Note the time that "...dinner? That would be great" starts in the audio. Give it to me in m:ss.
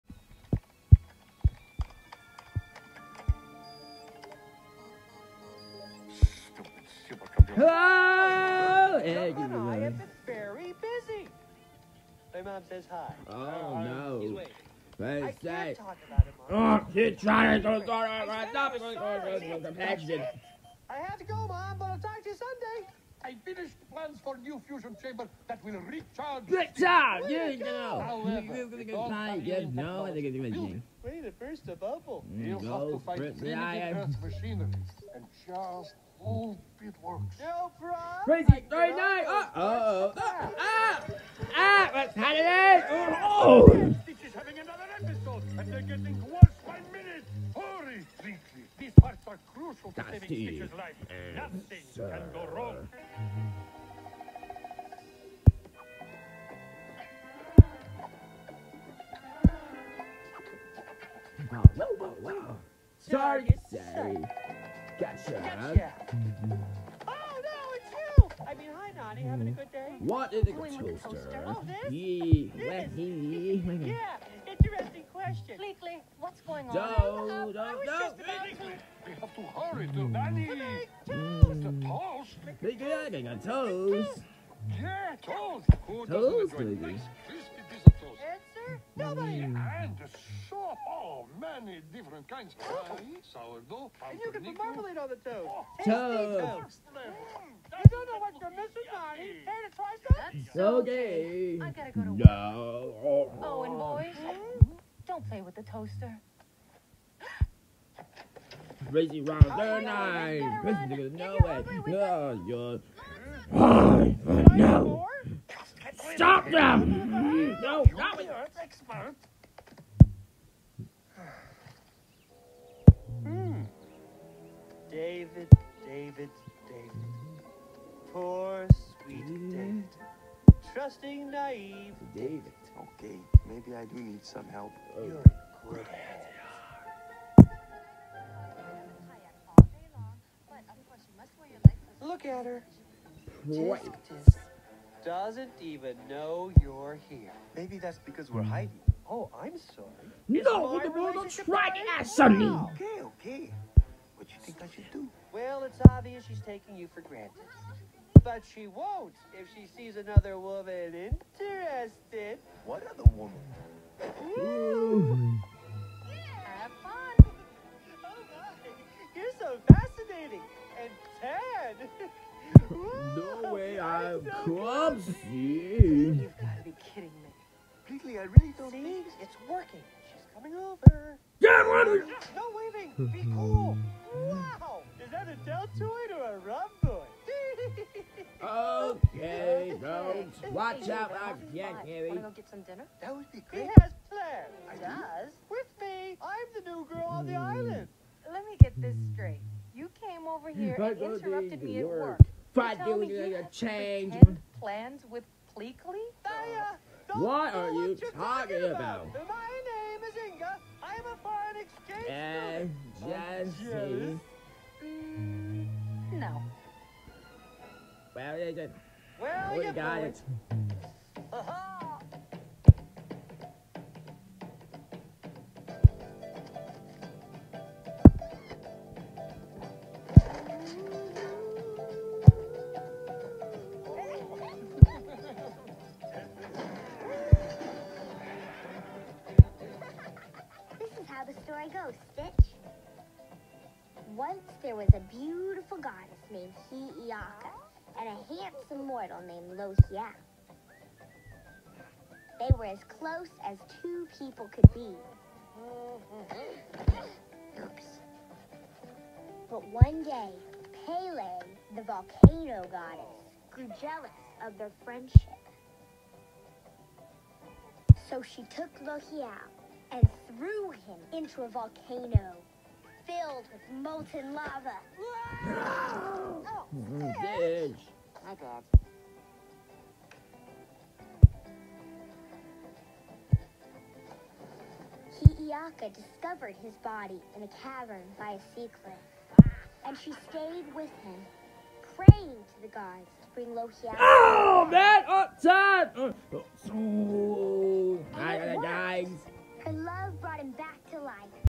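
3:12.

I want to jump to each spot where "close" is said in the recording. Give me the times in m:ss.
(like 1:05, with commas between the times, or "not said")
4:12.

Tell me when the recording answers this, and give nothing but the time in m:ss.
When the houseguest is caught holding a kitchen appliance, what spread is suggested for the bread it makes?
1:34.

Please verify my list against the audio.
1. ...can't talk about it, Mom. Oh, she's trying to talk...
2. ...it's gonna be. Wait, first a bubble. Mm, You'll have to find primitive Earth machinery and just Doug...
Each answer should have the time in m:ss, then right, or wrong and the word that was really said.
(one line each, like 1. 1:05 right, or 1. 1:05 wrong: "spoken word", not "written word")
1. 0:15 right
2. 0:30 wrong: "Old", not "Doug".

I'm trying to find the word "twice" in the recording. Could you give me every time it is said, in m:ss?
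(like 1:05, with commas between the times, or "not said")
1:39.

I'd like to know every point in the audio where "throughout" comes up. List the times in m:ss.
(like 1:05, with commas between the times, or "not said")
not said.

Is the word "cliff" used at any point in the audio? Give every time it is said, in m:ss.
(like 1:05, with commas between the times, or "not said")
4:48.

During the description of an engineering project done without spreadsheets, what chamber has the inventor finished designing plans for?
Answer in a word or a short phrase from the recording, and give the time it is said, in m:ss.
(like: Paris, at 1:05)
fusion chamber, at 0:24.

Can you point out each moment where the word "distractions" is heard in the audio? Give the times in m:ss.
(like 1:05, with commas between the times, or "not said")
not said.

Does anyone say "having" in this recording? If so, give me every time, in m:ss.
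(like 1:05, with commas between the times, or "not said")
0:44, 1:09.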